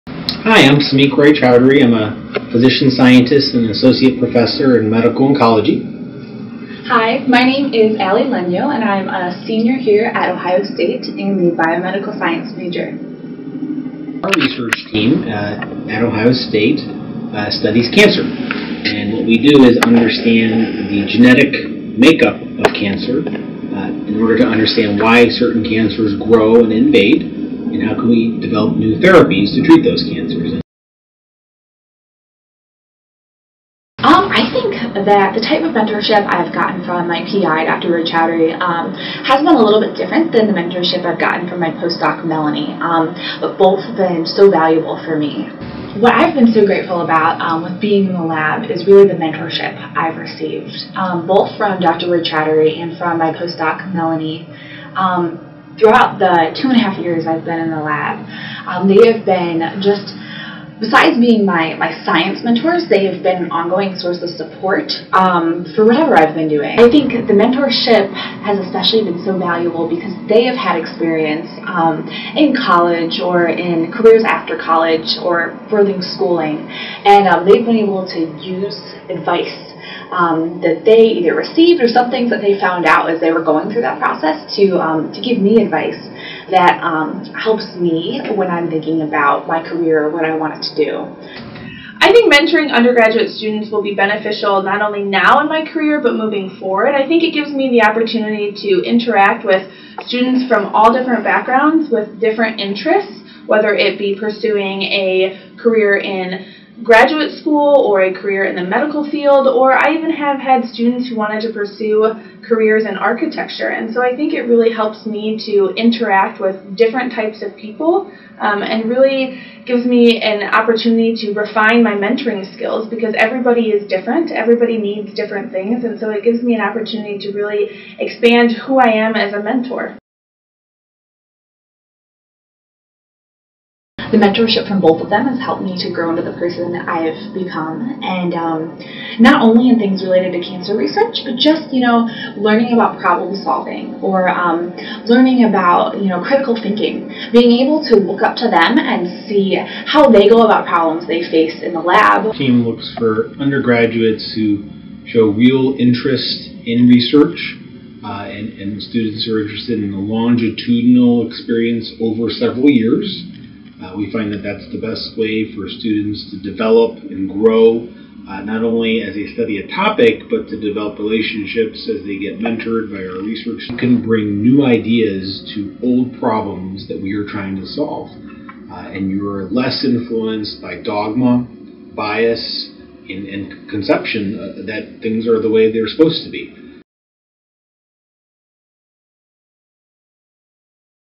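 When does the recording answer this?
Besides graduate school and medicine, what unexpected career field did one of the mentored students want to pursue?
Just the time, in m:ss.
1:52.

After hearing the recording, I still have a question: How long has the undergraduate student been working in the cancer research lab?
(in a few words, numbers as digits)
2.5 years.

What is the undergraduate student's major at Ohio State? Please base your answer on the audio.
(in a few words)
Biomedical science.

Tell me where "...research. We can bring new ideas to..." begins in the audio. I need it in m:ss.
2:53.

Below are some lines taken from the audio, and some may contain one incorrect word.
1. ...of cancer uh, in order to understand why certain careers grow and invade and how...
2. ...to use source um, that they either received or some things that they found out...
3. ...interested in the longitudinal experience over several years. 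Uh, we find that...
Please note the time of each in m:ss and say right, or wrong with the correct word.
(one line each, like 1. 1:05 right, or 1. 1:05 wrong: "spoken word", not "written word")
1. 0:22 wrong: "cancers", not "careers"
2. 1:18 wrong: "advice", not "source"
3. 2:39 right.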